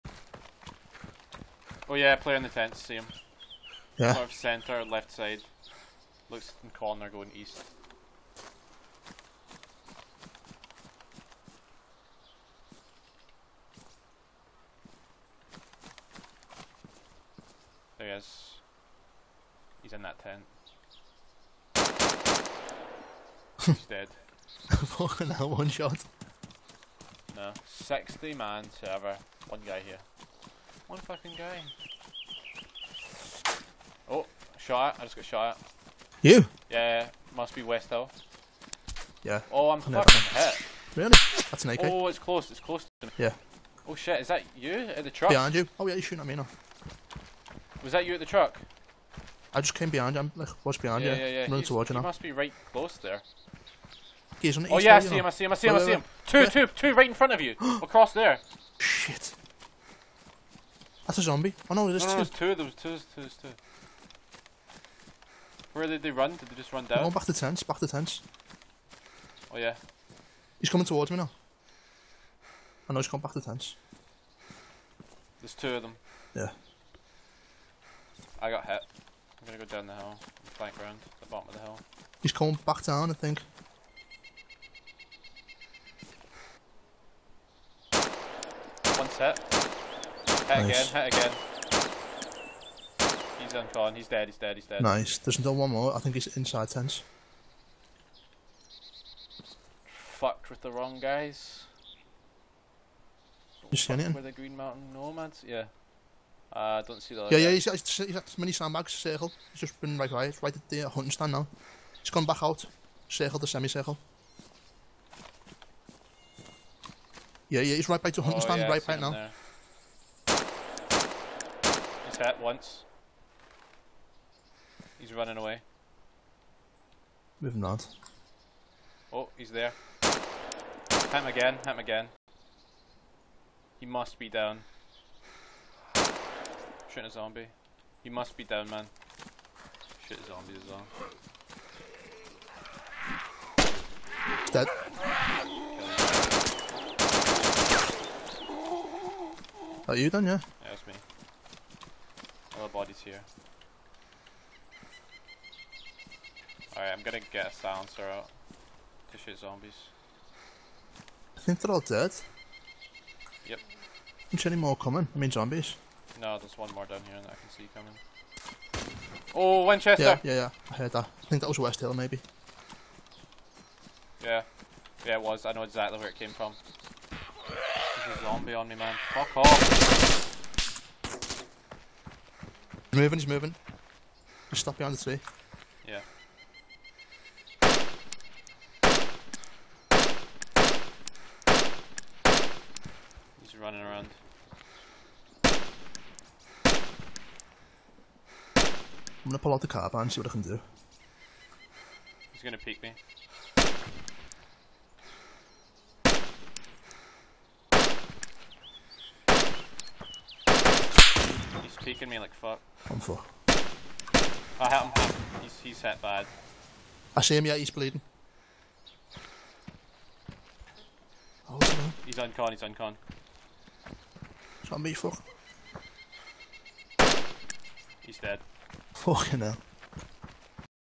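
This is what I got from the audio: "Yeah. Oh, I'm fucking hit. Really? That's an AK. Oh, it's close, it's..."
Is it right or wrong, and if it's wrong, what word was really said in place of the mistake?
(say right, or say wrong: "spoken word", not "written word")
right.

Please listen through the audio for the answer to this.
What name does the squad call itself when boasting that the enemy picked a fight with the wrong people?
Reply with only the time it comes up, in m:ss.
1:44.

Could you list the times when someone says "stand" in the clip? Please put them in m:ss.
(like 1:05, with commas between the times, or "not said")
1:51, 1:58.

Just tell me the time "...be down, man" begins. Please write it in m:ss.
2:18.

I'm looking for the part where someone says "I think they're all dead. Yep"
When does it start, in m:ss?
2:41.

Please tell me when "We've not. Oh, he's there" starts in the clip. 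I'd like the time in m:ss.
2:07.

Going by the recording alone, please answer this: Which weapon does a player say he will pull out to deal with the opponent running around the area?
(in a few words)
Carbine.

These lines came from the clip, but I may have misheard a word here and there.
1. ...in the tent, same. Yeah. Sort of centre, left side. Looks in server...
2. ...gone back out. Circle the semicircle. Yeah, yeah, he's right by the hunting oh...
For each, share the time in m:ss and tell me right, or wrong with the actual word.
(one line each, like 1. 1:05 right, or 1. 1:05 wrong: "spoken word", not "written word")
1. 0:02 wrong: "corner", not "server"
2. 1:52 right.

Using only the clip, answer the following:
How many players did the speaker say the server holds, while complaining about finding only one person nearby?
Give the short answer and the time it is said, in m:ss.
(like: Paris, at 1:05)
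60, at 0:27.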